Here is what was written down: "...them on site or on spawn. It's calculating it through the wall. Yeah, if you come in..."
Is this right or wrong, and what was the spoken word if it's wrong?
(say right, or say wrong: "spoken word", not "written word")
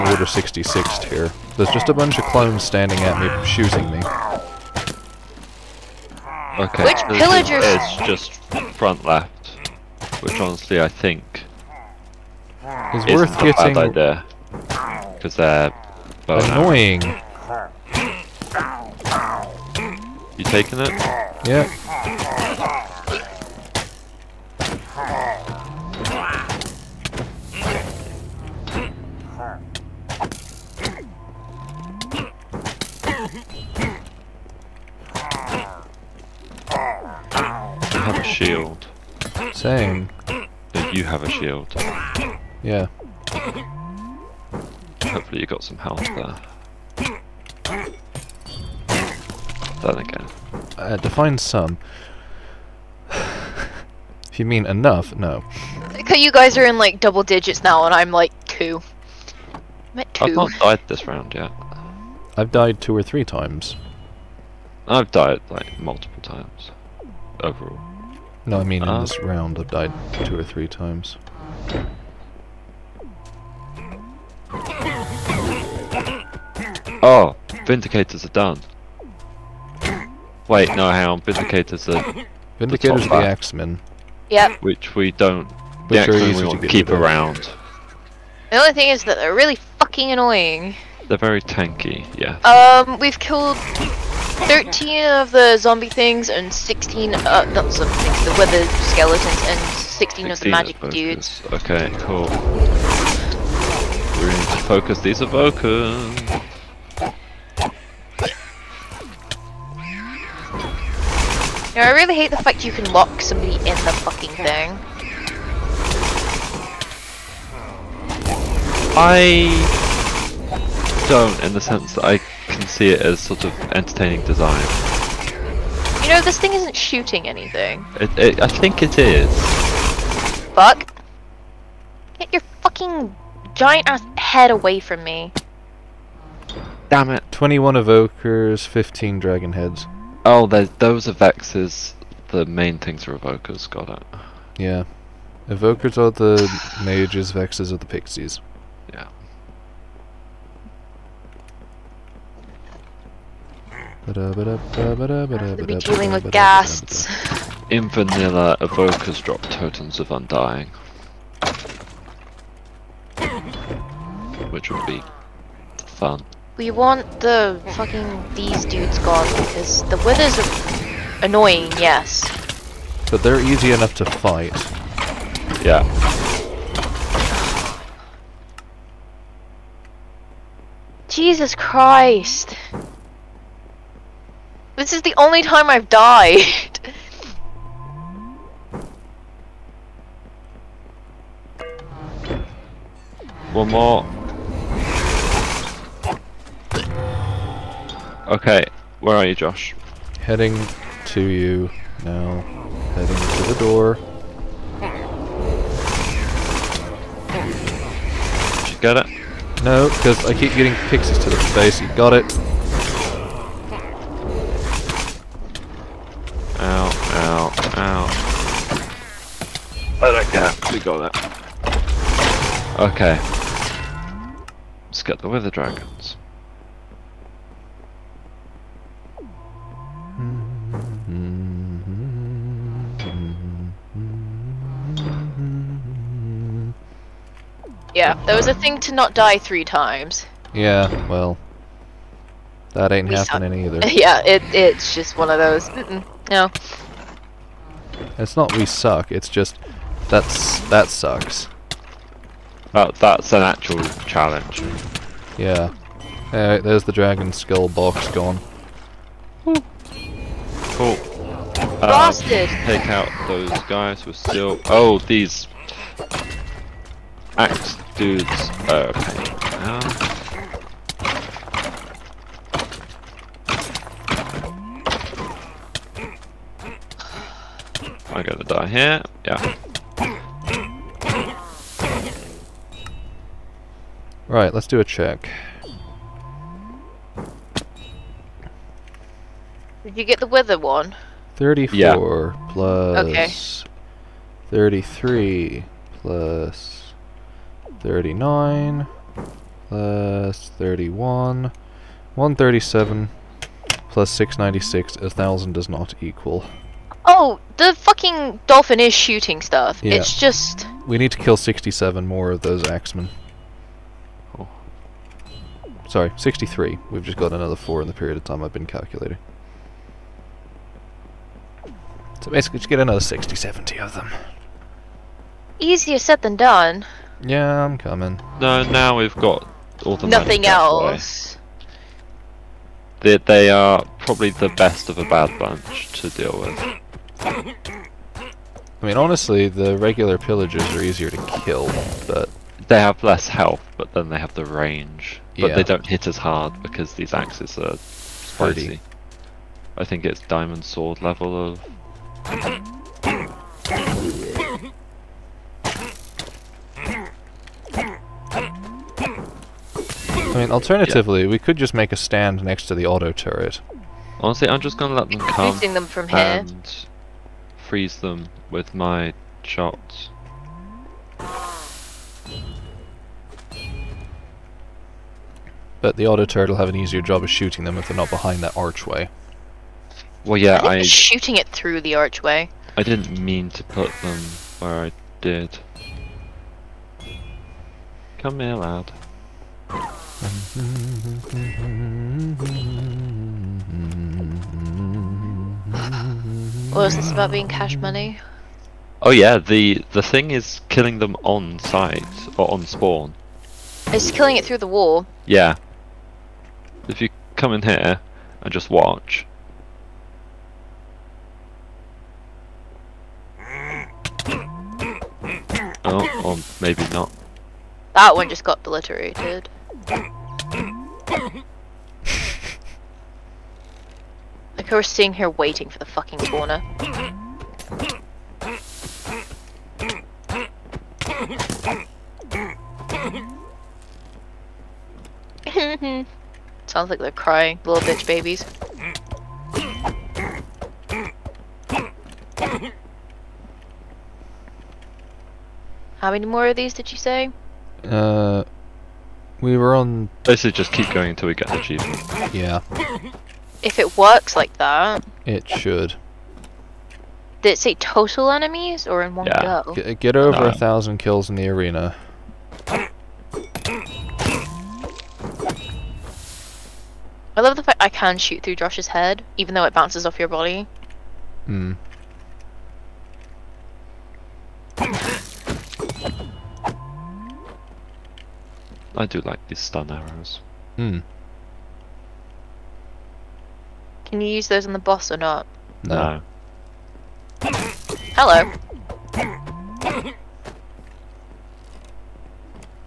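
wrong: "killing", not "calculating".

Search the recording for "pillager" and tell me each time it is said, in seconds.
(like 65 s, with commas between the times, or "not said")
7 s, 340 s.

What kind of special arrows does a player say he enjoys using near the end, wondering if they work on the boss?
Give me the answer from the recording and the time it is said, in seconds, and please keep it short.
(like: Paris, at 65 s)
stun arrows, at 479 s.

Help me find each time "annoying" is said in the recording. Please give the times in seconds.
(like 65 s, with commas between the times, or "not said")
16 s, 90 s, 171 s.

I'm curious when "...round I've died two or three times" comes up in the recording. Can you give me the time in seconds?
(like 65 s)
69 s.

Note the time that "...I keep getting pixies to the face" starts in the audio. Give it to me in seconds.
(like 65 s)
210 s.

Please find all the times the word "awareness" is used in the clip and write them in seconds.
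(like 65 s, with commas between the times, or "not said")
not said.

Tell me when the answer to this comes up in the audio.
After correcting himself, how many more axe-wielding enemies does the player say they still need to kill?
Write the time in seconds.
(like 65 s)
315 s.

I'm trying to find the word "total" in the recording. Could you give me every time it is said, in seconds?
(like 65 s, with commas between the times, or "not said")
457 s.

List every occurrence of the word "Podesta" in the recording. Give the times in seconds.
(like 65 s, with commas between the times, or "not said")
not said.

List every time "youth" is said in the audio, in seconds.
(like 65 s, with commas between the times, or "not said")
not said.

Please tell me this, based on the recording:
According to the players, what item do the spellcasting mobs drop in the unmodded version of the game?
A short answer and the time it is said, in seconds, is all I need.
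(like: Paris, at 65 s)
totems of undying, at 159 s.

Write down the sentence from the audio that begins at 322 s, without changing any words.
So basically just get another 60, 70 of them.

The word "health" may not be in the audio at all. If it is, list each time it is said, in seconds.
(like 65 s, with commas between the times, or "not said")
45 s, 343 s.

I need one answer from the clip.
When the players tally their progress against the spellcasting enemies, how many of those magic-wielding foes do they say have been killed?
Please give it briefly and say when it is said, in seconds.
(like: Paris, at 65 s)
16, at 100 s.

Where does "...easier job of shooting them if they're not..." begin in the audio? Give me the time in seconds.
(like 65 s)
376 s.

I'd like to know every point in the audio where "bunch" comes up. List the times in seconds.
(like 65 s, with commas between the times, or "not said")
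1 s, 335 s.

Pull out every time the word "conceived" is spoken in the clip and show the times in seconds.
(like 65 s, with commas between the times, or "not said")
not said.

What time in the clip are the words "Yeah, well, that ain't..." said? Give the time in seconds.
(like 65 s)
240 s.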